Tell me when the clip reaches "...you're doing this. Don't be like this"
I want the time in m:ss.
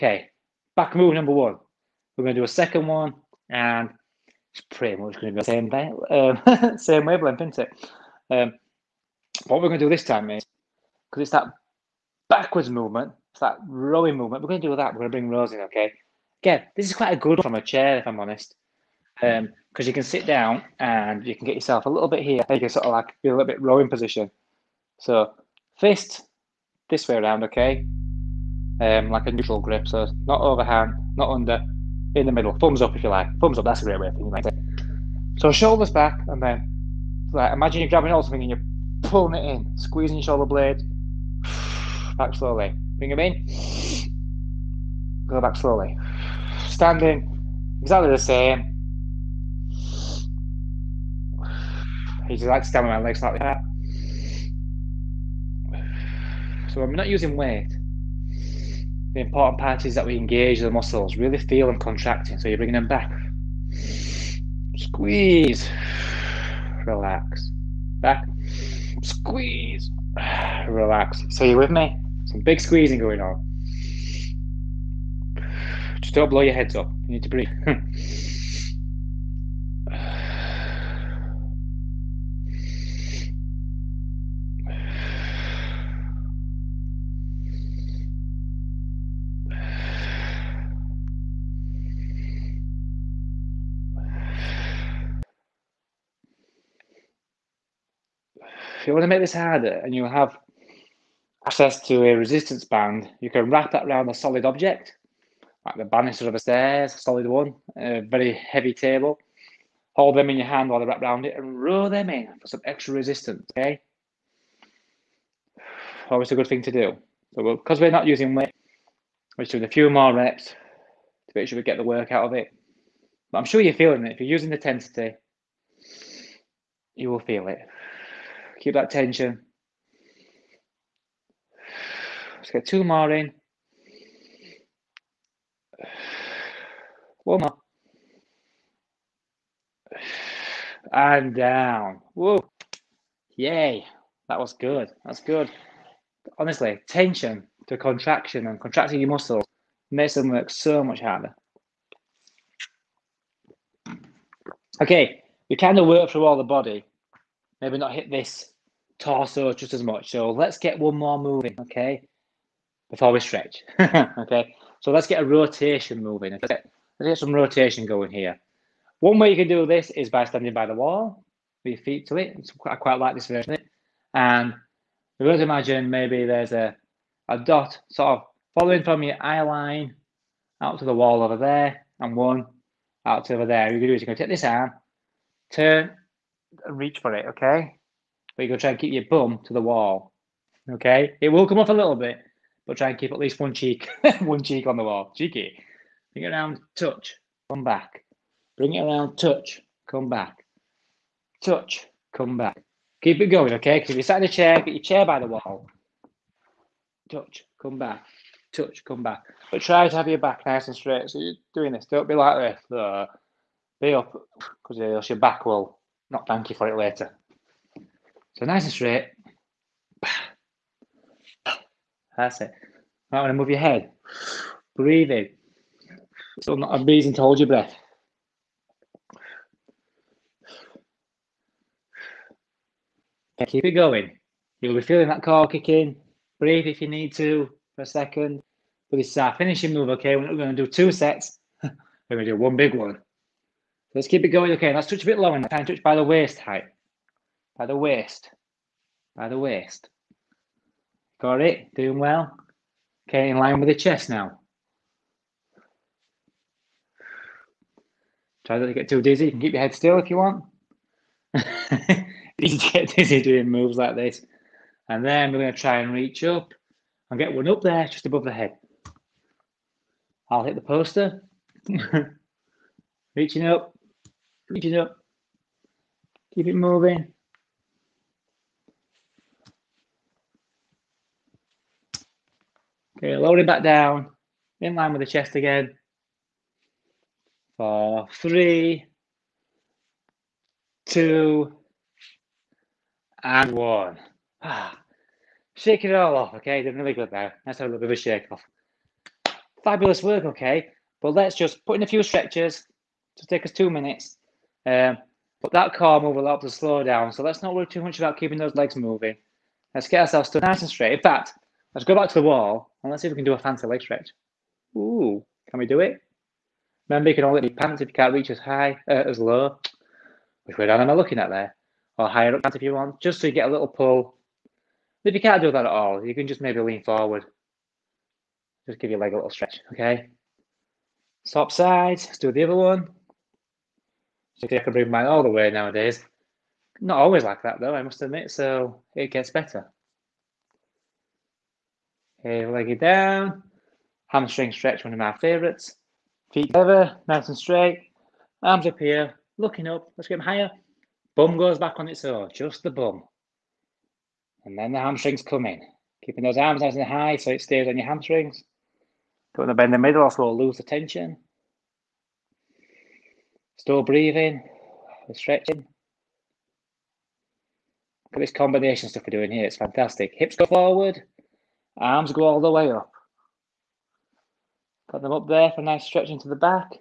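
3:31.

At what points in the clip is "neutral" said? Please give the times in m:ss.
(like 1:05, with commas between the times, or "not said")
0:29.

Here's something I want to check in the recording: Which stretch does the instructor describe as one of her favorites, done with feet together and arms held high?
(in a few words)
Hamstring stretch.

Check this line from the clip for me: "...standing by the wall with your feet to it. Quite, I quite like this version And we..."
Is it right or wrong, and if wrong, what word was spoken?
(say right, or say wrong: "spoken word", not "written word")
right.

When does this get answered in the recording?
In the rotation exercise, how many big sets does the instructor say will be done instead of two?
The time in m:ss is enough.
4:02.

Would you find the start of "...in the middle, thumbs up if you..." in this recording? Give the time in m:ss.
0:32.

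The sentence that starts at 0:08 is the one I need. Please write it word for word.
Um, what we're going to do this time is because it's that backwards movement, it's that rowing movement.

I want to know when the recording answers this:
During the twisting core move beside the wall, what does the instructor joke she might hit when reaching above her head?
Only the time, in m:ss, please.
4:30.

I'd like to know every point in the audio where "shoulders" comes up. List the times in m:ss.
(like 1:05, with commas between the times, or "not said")
0:35, 0:40.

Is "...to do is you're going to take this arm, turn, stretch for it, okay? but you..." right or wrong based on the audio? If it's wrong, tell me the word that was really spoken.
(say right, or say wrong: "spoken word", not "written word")
wrong: "reach", not "stretch".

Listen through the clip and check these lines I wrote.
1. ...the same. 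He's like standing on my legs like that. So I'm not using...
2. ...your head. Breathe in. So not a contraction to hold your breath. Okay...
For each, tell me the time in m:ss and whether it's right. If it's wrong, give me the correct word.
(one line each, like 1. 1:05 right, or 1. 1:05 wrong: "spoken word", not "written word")
1. 0:48 right
2. 3:43 wrong: "reason", not "contraction".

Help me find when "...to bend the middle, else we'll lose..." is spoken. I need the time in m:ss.
5:59.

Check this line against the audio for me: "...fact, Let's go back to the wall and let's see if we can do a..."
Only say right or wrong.
right.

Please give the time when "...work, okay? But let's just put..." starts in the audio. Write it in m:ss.
5:00.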